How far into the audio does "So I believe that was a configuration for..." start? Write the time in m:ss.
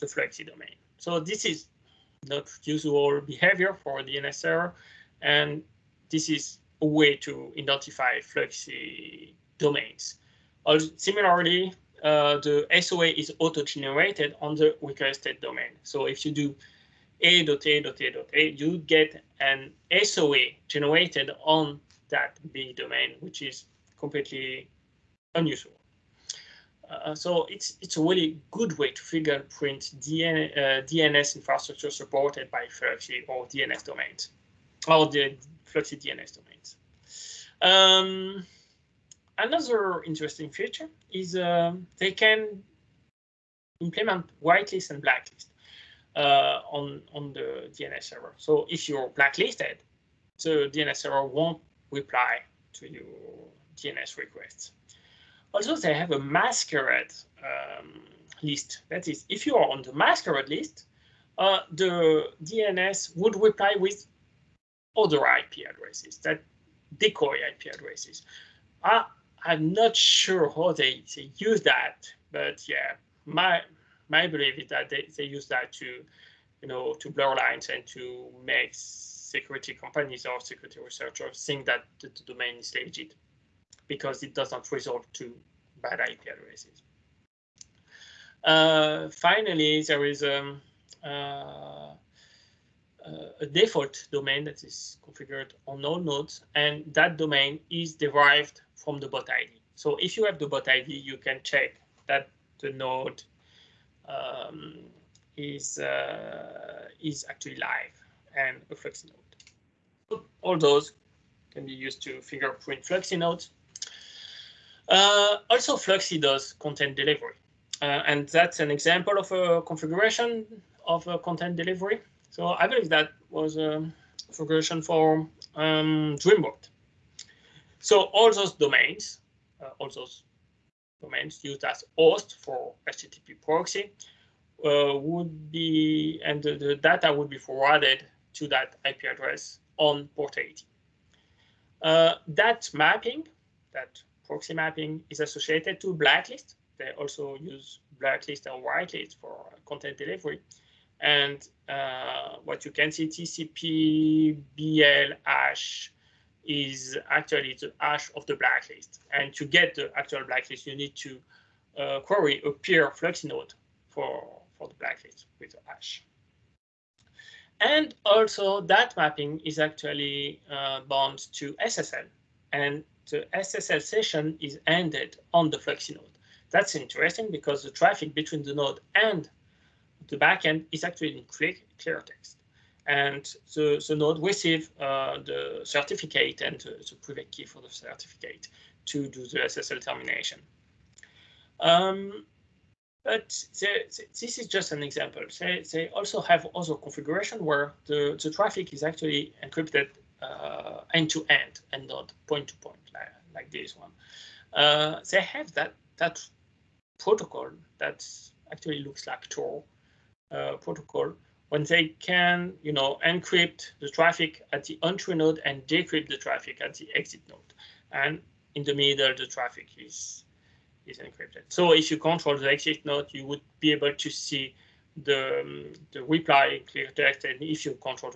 2:02.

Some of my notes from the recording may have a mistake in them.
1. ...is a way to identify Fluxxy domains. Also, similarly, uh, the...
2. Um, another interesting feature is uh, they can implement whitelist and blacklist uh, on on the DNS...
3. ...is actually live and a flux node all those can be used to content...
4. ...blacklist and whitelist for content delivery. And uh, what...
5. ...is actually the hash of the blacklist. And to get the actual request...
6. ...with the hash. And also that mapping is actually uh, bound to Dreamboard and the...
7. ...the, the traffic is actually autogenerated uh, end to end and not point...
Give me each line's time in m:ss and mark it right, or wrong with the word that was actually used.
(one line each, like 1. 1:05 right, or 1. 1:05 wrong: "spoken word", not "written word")
1. 0:06 right
2. 0:37 right
3. 1:47 wrong: "fingerprint", not "content"
4. 2:27 right
5. 2:36 wrong: "blacklist", not "request"
6. 2:45 wrong: "SSL", not "Dreamboard"
7. 3:17 wrong: "encrypted", not "autogenerated".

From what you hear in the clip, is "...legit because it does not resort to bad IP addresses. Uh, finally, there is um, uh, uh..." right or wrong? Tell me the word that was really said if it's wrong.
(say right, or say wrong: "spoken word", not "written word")
right.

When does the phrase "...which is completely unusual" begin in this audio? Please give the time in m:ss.
0:23.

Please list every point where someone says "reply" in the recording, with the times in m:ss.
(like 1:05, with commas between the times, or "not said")
0:51, 1:03, 3:46.